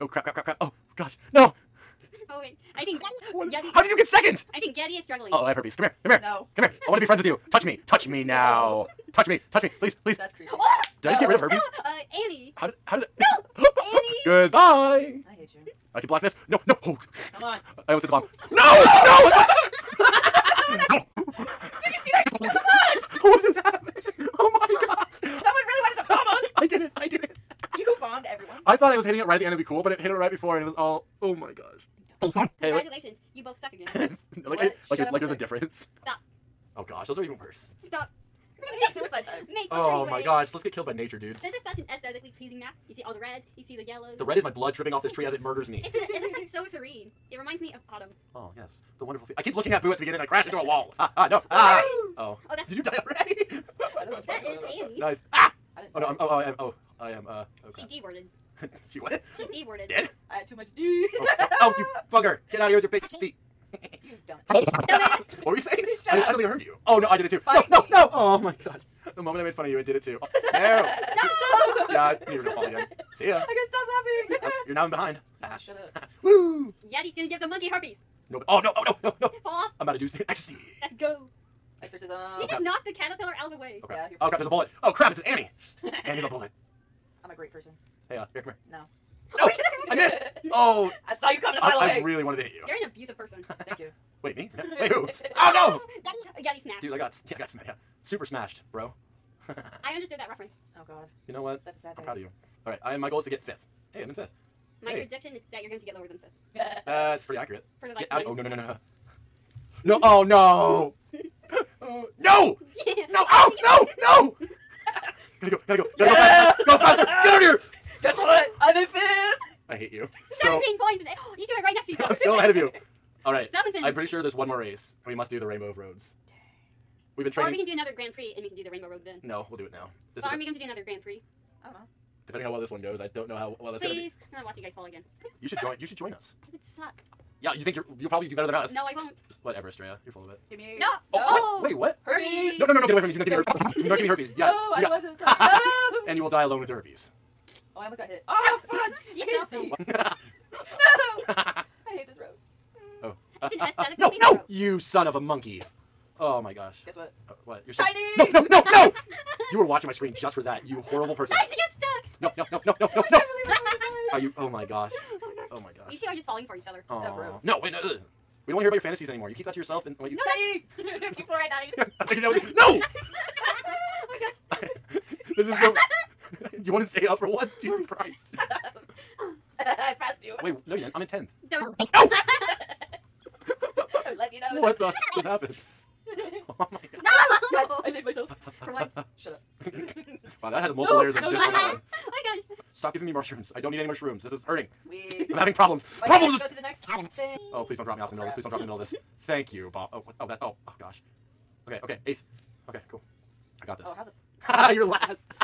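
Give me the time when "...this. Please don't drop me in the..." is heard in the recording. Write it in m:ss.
3:18.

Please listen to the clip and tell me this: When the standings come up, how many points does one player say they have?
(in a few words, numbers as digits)
17.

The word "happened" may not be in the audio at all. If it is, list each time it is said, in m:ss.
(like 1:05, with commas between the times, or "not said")
0:23, 3:05.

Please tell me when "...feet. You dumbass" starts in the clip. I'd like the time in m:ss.
1:03.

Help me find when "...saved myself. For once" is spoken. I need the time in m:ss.
3:07.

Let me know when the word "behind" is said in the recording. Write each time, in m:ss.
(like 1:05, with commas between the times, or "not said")
1:14.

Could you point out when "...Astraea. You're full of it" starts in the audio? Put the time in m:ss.
2:19.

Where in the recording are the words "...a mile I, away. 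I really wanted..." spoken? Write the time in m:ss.
1:31.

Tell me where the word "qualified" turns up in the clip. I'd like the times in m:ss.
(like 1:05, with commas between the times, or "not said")
not said.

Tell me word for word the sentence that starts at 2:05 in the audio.
We must do the Rainbow of Roads.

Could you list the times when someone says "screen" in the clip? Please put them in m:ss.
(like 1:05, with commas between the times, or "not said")
2:39.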